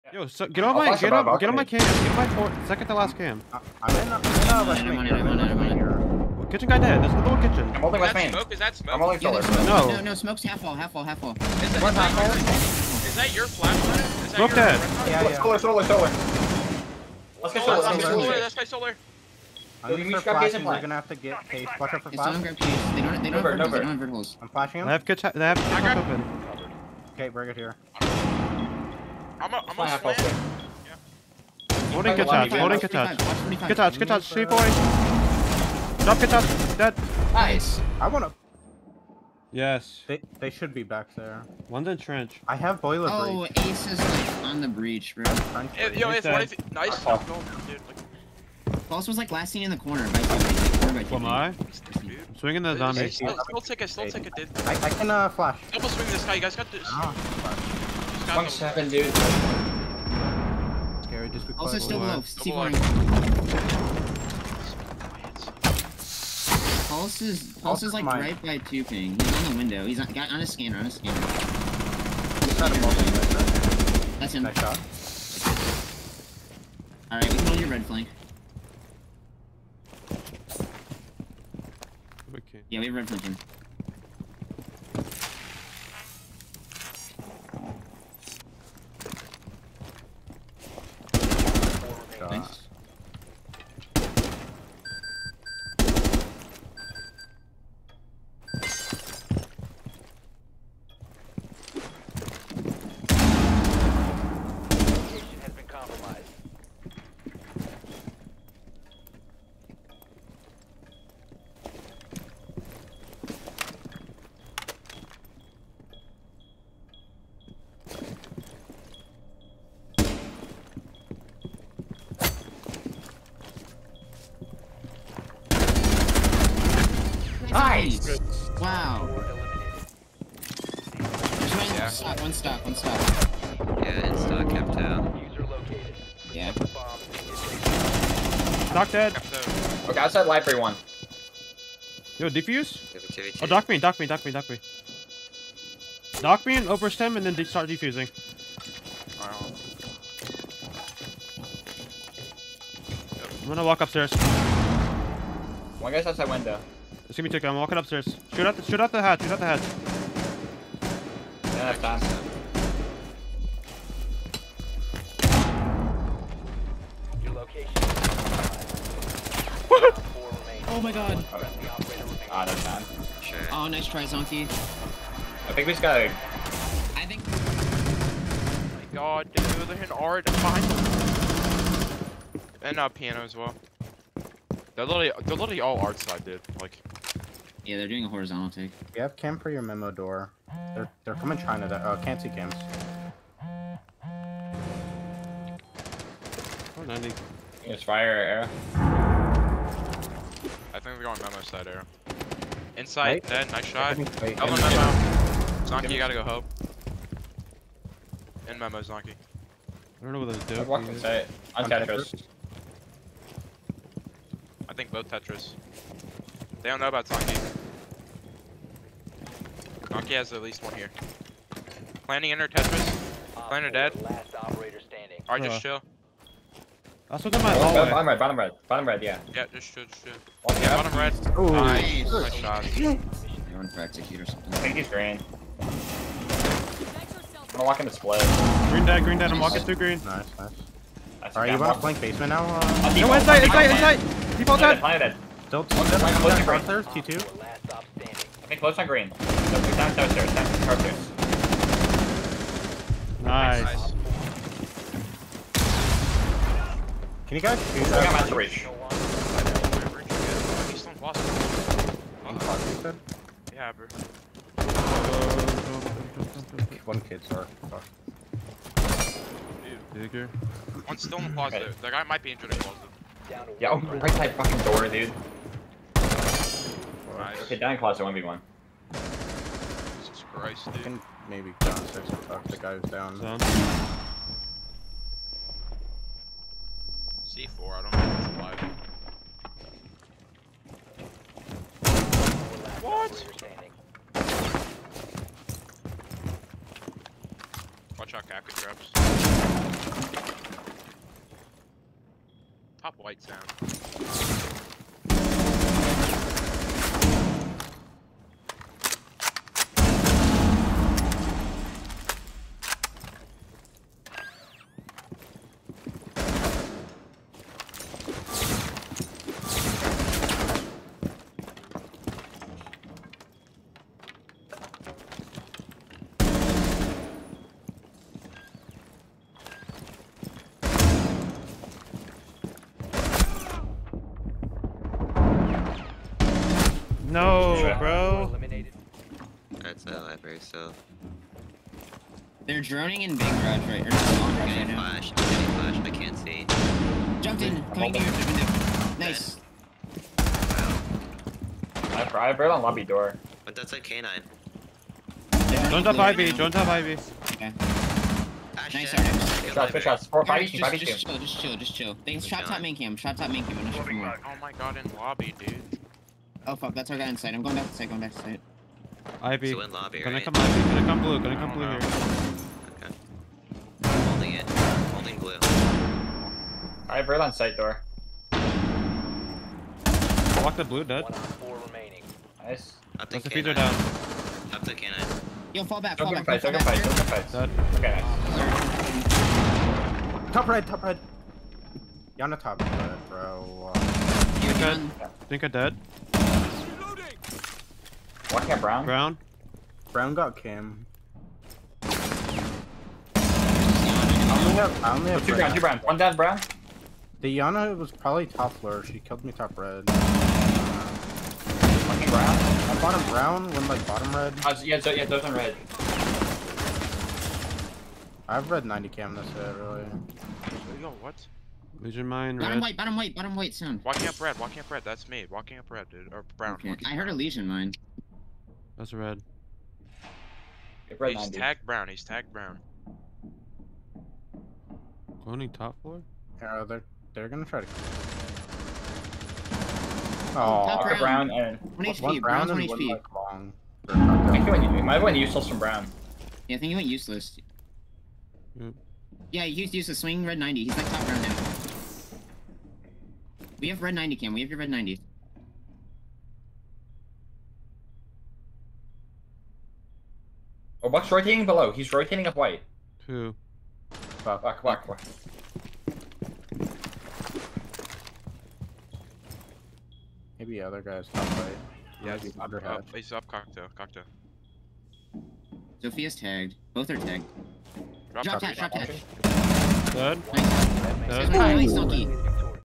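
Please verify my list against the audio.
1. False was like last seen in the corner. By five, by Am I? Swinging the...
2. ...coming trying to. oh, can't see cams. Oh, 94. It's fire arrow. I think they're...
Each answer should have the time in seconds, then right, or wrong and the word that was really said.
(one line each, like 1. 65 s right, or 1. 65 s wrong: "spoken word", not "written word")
1. 48 s wrong: "two", not "five"
2. 191 s wrong: "90", not "94".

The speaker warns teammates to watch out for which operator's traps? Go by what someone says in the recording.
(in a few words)
Kapkan.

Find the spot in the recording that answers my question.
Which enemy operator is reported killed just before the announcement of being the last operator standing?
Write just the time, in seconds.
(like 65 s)
223 s.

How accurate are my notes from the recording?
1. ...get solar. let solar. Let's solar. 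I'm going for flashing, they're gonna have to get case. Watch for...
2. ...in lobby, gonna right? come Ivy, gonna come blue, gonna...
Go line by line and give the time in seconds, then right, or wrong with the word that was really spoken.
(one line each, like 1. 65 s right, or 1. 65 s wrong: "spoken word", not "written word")
1. 17 s right
2. 369 s right.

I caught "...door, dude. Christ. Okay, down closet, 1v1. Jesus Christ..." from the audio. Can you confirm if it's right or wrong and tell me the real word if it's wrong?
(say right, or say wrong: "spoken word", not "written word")
right.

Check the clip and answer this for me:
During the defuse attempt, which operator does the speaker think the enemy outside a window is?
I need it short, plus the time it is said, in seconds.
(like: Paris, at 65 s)
Tico, at 157 s.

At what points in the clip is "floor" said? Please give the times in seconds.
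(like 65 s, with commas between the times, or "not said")
408 s, 435 s.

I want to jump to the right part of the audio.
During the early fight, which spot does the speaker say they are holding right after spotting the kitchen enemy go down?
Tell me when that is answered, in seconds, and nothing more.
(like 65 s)
8 s.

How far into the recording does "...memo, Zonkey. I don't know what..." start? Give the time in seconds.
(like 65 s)
208 s.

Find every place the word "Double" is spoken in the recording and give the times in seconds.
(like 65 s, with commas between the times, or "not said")
55 s.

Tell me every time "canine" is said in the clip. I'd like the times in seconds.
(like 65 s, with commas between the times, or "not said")
353 s, 384 s.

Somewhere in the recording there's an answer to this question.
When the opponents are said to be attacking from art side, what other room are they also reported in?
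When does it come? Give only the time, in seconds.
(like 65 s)
182 s.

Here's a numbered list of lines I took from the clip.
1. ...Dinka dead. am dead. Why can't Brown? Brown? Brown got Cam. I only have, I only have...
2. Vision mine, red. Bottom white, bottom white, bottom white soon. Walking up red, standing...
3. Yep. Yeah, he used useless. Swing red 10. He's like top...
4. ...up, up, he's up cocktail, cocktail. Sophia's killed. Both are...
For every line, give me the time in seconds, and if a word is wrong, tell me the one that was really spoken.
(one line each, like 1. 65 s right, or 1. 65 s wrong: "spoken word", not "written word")
1. 395 s right
2. 421 s wrong: "walking", not "standing"
3. 448 s wrong: "90", not "10"
4. 472 s wrong: "tagged", not "killed".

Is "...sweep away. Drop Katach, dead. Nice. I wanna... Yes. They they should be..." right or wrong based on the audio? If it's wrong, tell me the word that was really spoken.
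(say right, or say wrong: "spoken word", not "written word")
right.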